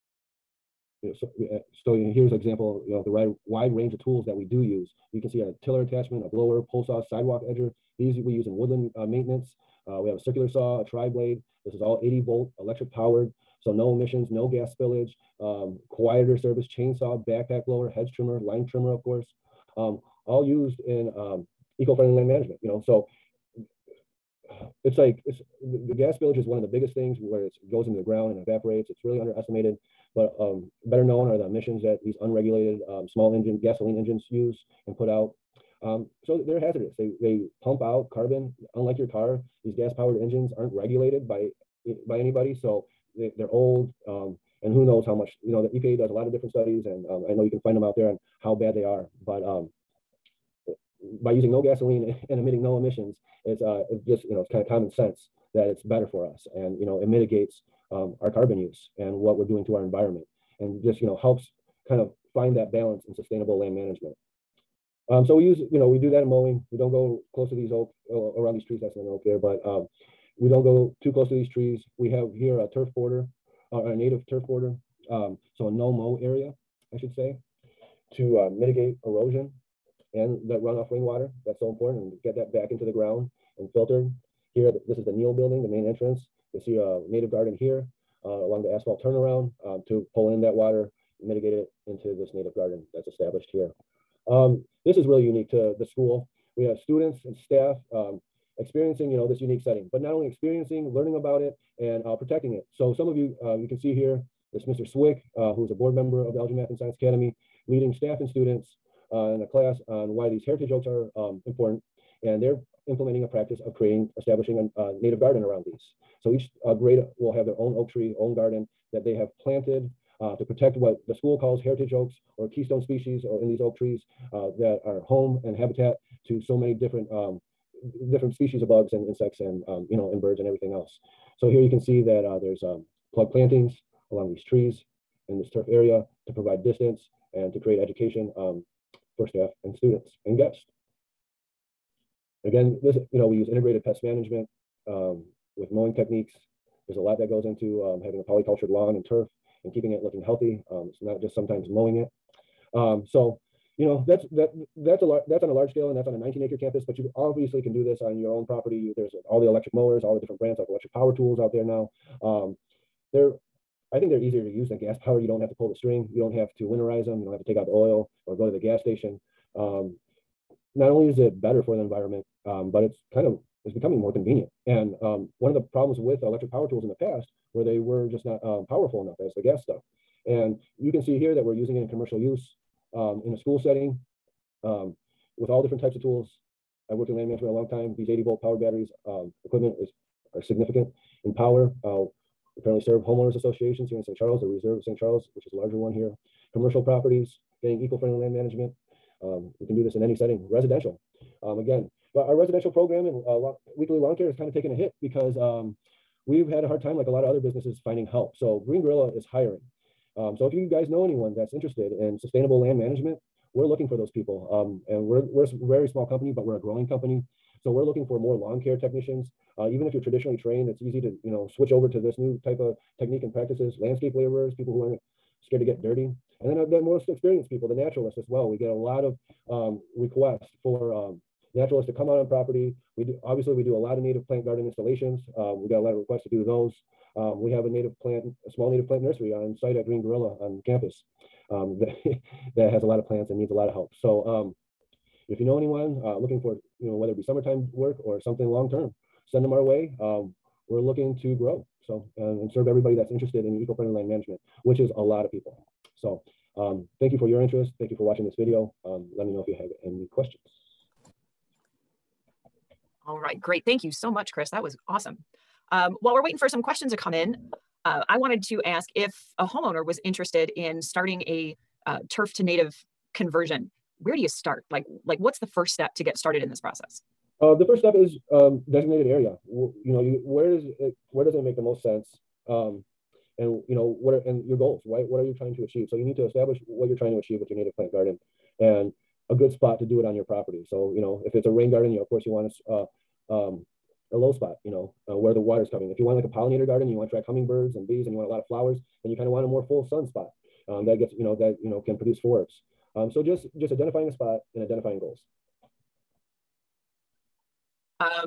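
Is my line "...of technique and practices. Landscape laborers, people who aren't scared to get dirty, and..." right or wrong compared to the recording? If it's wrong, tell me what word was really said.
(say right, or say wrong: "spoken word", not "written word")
right.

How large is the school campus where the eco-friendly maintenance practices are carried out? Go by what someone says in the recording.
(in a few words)
19 acres.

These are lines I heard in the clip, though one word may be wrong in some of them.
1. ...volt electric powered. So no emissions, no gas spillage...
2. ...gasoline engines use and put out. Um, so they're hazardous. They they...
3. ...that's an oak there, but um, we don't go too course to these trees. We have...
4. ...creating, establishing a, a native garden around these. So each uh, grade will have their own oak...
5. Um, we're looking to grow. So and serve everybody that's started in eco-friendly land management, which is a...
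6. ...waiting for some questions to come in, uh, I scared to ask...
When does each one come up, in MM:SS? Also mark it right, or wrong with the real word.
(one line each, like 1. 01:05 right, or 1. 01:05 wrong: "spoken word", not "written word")
1. 00:12 right
2. 00:33 right
3. 01:08 wrong: "close", not "course"
4. 01:53 right
5. 04:10 wrong: "interested", not "started"
6. 04:26 wrong: "wanted", not "scared".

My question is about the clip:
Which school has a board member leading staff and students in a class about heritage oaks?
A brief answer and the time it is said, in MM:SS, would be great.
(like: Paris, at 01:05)
Elgin Math and Science Academy, at 01:46.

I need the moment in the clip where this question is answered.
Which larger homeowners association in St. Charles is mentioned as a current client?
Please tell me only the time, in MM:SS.
03:14.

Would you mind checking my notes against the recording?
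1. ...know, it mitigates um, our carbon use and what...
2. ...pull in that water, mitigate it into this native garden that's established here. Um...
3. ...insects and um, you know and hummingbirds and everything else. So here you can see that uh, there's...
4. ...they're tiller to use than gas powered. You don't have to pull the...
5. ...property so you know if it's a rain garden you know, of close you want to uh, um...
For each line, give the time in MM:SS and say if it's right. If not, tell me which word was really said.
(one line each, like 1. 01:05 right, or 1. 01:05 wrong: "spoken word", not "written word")
1. 00:56 right
2. 01:30 right
3. 02:09 wrong: "birds", not "hummingbirds"
4. 02:44 wrong: "easier", not "tiller"
5. 04:50 wrong: "course", not "close".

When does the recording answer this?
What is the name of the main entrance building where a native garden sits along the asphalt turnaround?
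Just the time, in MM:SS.
01:25.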